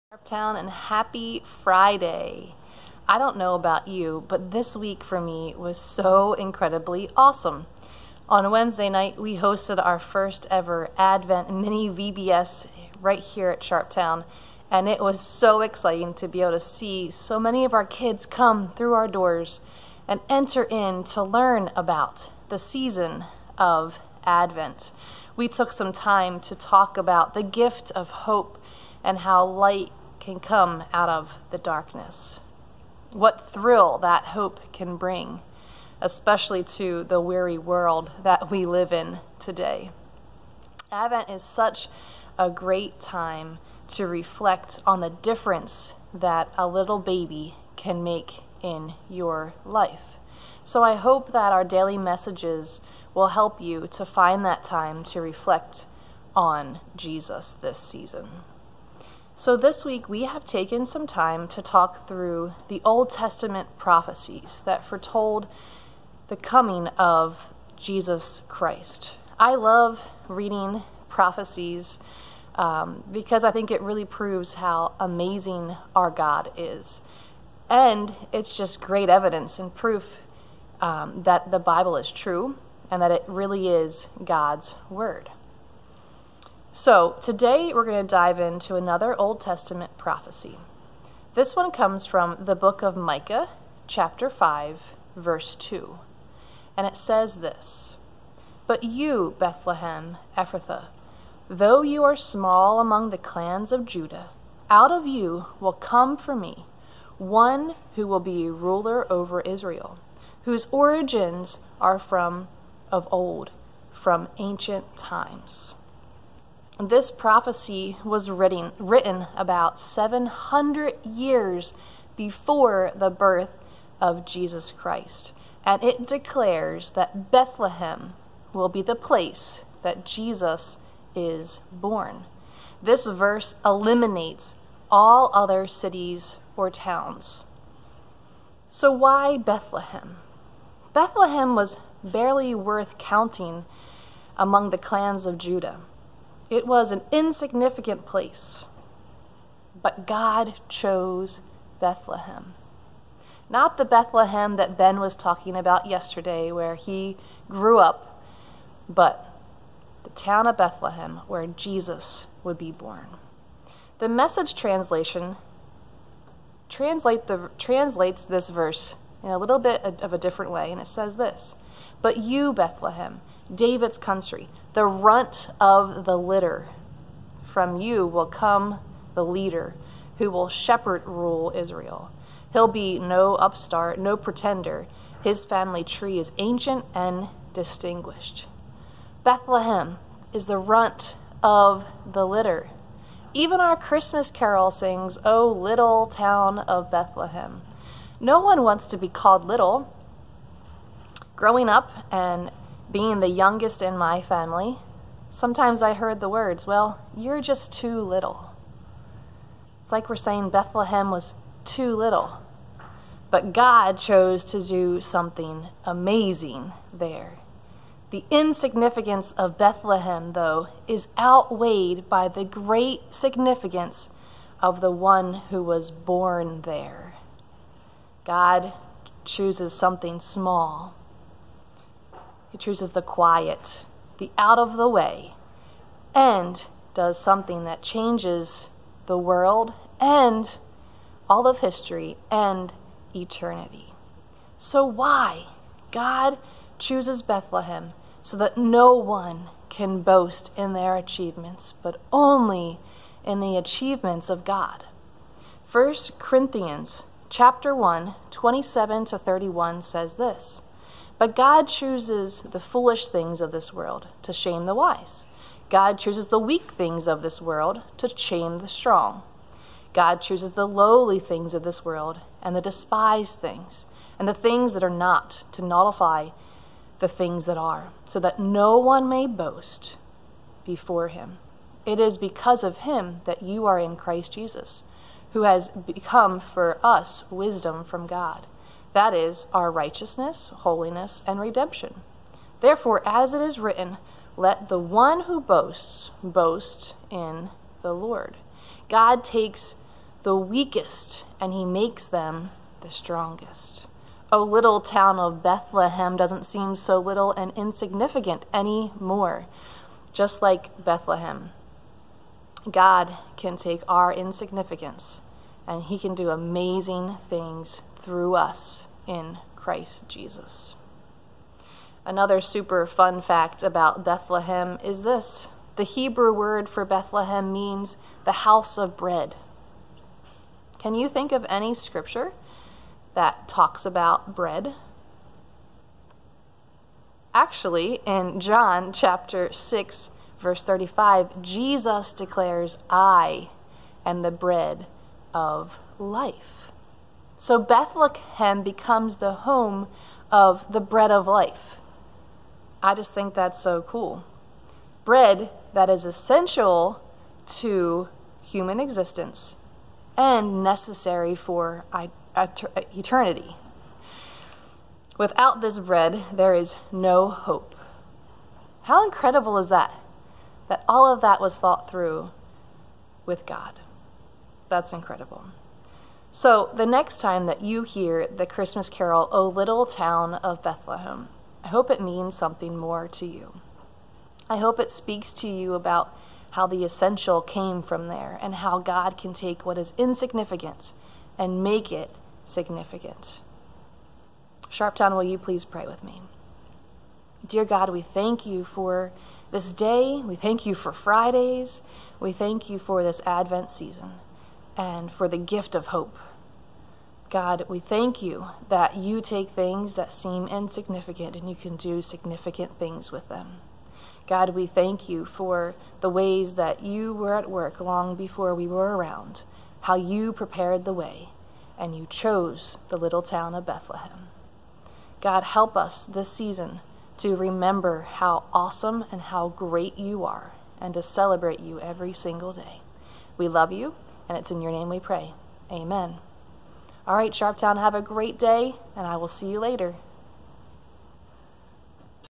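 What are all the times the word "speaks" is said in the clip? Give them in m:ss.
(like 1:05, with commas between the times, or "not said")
6:24.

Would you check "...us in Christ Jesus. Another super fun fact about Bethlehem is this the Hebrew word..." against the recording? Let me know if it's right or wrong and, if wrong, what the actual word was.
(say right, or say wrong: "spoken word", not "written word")
right.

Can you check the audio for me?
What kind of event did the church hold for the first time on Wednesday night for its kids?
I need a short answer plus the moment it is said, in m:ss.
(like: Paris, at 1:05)
Advent mini VBS, at 0:10.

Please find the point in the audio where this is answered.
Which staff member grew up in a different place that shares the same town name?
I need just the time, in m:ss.
2:34.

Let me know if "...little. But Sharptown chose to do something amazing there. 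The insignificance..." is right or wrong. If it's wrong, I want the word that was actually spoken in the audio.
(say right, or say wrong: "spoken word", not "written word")
wrong: "God", not "Sharptown".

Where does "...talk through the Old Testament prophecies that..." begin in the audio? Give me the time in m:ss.
1:01.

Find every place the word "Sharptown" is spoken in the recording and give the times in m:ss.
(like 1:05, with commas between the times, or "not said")
0:00, 0:13, 6:34, 7:17.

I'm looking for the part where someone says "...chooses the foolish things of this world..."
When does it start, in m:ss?
4:21.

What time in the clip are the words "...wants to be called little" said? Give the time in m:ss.
3:18.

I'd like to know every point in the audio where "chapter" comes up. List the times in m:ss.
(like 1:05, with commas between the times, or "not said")
1:33, 4:17, 5:38.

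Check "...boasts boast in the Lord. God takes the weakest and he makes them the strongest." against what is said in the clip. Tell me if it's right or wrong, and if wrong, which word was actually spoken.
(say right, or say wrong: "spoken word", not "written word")
right.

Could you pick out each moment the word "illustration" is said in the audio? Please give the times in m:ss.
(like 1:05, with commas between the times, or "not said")
not said.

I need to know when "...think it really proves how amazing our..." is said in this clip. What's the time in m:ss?
1:13.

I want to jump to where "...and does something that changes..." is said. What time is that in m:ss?
3:56.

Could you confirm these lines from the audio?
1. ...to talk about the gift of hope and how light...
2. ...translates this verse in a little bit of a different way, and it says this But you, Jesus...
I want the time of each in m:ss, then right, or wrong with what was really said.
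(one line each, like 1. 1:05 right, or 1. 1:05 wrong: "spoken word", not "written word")
1. 0:26 right
2. 2:47 wrong: "Bethlehem", not "Jesus".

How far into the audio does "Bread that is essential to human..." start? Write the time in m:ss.
5:55.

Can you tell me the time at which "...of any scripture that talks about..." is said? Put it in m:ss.
5:31.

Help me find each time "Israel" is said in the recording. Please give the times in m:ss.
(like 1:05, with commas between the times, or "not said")
1:49, 3:01.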